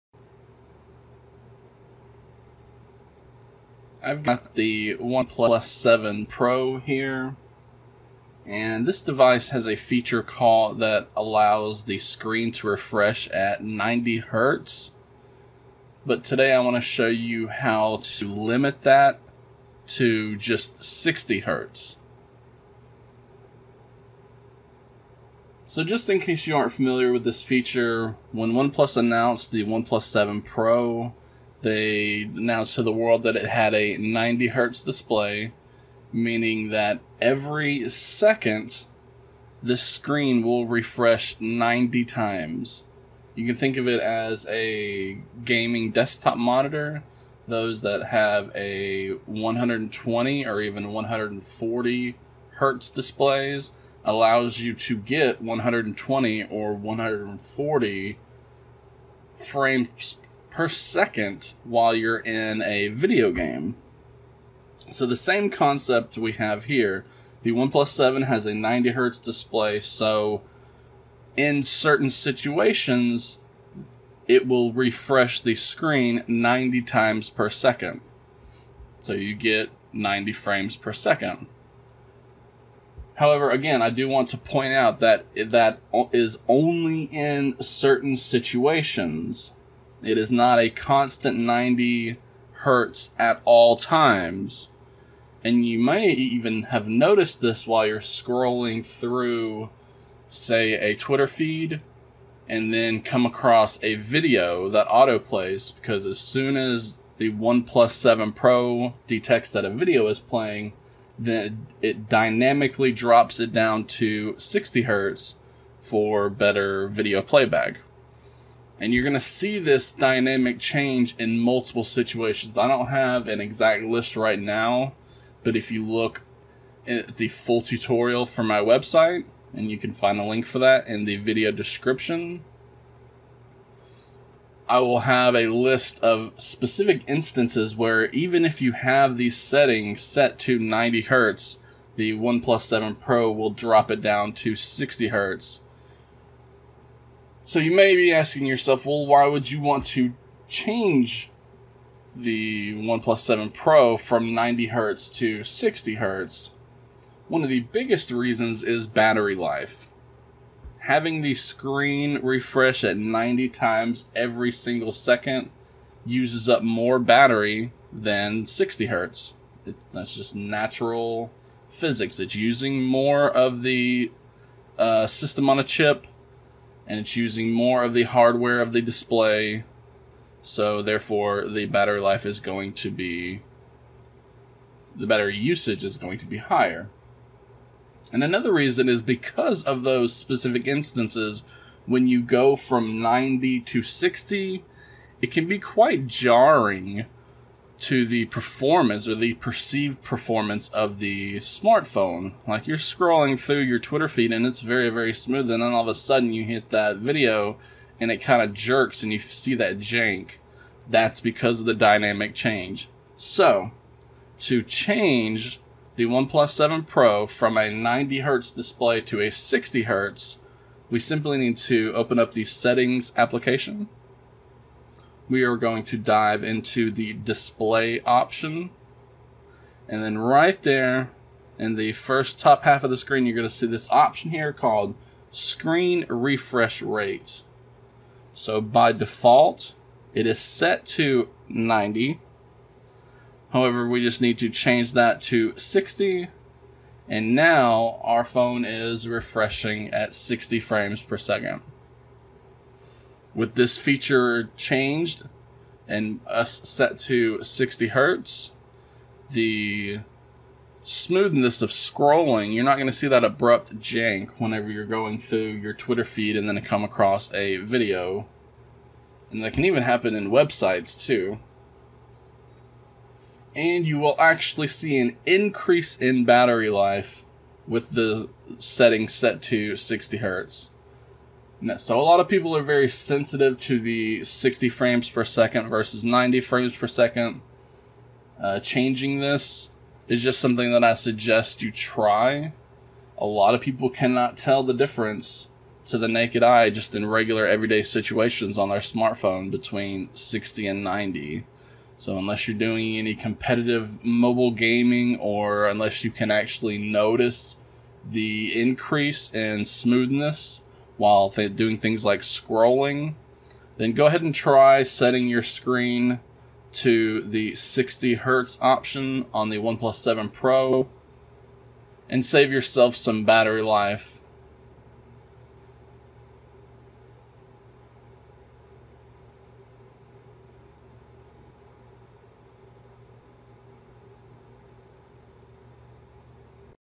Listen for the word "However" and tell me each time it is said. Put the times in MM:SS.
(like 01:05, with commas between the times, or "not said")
01:23, 04:03.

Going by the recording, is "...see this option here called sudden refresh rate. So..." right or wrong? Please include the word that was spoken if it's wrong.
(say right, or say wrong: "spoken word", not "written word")
wrong: "screen", not "sudden".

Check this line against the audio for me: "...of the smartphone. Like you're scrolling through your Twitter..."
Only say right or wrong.
right.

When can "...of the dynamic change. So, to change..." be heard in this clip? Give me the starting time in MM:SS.
03:31.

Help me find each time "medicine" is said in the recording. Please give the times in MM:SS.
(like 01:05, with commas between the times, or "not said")
not said.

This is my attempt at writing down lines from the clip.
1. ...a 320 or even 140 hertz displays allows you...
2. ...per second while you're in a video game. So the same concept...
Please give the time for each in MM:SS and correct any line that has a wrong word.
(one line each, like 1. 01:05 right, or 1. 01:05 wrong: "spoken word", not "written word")
1. 00:48 wrong: "120", not "320"
2. 01:00 right.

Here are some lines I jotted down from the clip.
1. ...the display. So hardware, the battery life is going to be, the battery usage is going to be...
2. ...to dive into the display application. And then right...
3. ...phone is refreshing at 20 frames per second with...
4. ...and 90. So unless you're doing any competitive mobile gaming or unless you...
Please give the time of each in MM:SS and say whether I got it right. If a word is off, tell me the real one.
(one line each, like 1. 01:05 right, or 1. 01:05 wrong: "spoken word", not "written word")
1. 02:58 wrong: "therefore", not "hardware"
2. 03:45 wrong: "option", not "application"
3. 04:08 wrong: "60", not "20"
4. 05:00 right.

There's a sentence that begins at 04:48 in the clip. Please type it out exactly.
Uh, changing this is just something that I suggest you try.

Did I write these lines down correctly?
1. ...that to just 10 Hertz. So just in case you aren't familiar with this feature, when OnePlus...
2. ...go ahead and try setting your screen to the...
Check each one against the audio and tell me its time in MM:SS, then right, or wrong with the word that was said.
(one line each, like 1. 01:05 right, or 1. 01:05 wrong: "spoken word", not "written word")
1. 00:18 wrong: "60", not "10"
2. 05:13 right.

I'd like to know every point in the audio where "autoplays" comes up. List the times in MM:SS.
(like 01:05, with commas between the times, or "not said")
01:44.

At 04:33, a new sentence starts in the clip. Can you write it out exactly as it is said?
And you will actually see an increase in battery life with the setting set to 60 hertz.